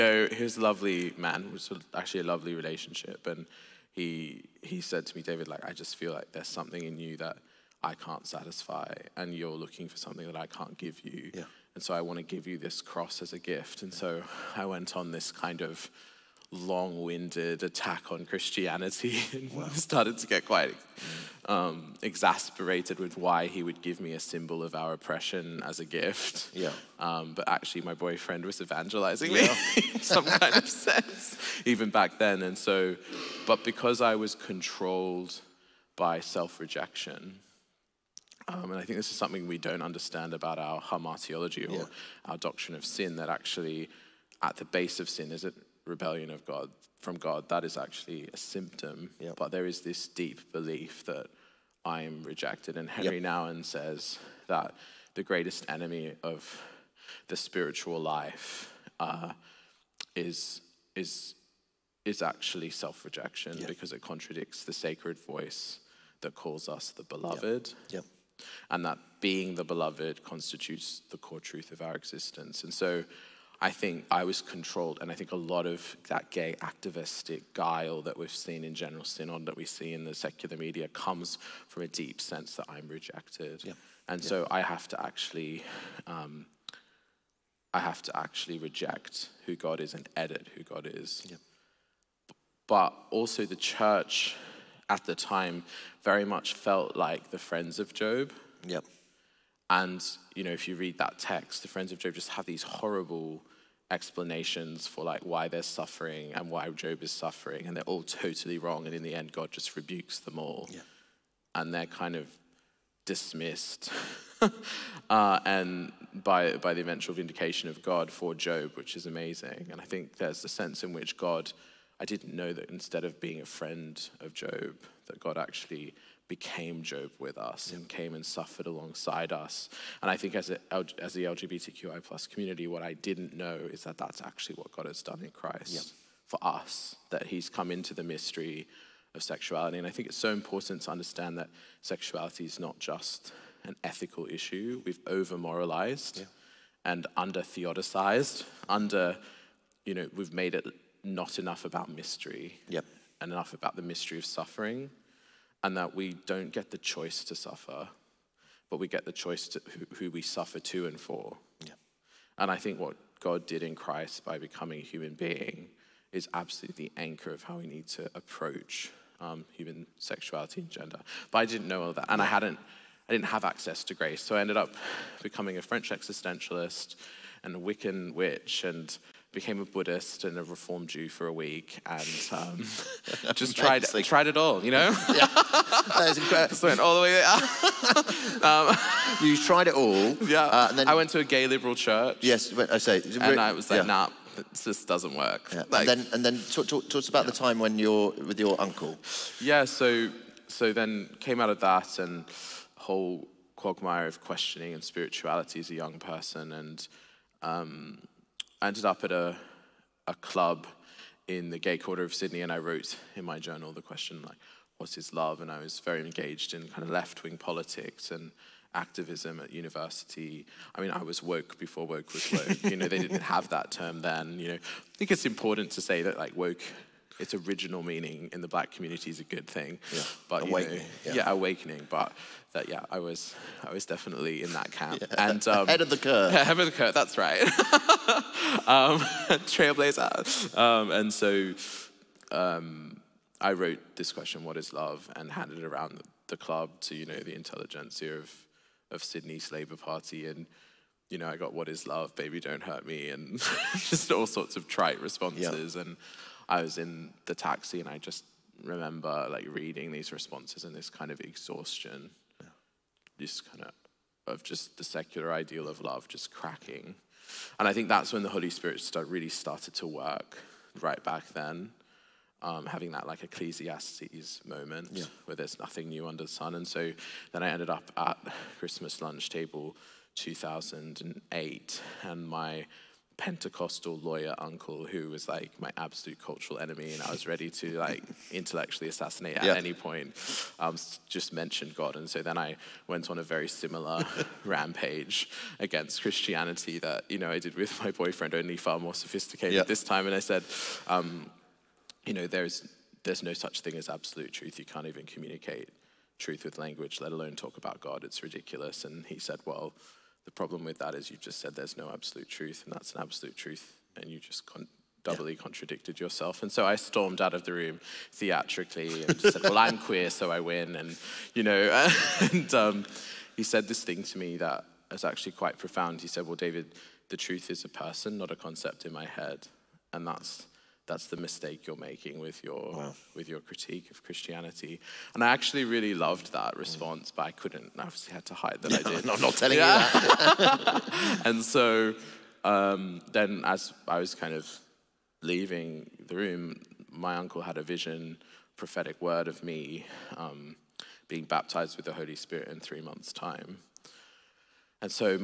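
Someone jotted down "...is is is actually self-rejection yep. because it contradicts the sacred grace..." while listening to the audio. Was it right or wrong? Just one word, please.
wrong.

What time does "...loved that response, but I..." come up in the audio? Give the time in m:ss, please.
5:35.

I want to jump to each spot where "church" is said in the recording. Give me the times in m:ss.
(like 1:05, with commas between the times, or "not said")
1:33, 3:11.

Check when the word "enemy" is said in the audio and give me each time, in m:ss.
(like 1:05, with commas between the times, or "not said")
0:55, 4:46.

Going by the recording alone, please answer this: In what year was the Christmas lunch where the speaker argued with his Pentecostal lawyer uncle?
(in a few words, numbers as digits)
2008.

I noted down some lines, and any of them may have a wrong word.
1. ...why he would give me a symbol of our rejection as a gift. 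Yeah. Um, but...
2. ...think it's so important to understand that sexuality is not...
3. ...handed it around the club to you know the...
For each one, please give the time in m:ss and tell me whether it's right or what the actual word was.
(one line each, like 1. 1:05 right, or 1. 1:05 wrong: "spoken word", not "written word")
1. 0:23 wrong: "oppression", not "rejection"
2. 2:19 right
3. 4:05 right.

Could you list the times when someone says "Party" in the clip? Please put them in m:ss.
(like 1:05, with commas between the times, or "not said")
4:09.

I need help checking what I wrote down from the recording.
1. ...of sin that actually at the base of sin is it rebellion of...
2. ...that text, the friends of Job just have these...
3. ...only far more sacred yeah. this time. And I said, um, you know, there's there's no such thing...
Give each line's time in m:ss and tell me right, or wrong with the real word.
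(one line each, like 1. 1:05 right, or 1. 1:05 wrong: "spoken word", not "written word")
1. 0:42 right
2. 1:40 right
3. 4:58 wrong: "sophisticated", not "sacred".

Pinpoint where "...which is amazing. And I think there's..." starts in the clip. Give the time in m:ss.
1:58.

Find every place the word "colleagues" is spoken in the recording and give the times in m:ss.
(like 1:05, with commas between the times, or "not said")
not said.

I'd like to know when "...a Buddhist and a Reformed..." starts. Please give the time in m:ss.
2:59.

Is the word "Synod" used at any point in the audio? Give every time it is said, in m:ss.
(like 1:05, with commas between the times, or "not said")
1:19.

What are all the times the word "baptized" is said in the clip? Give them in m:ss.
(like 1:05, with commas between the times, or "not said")
5:51.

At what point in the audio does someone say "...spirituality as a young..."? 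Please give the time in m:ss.
3:24.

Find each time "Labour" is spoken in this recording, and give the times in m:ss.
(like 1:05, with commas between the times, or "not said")
4:09.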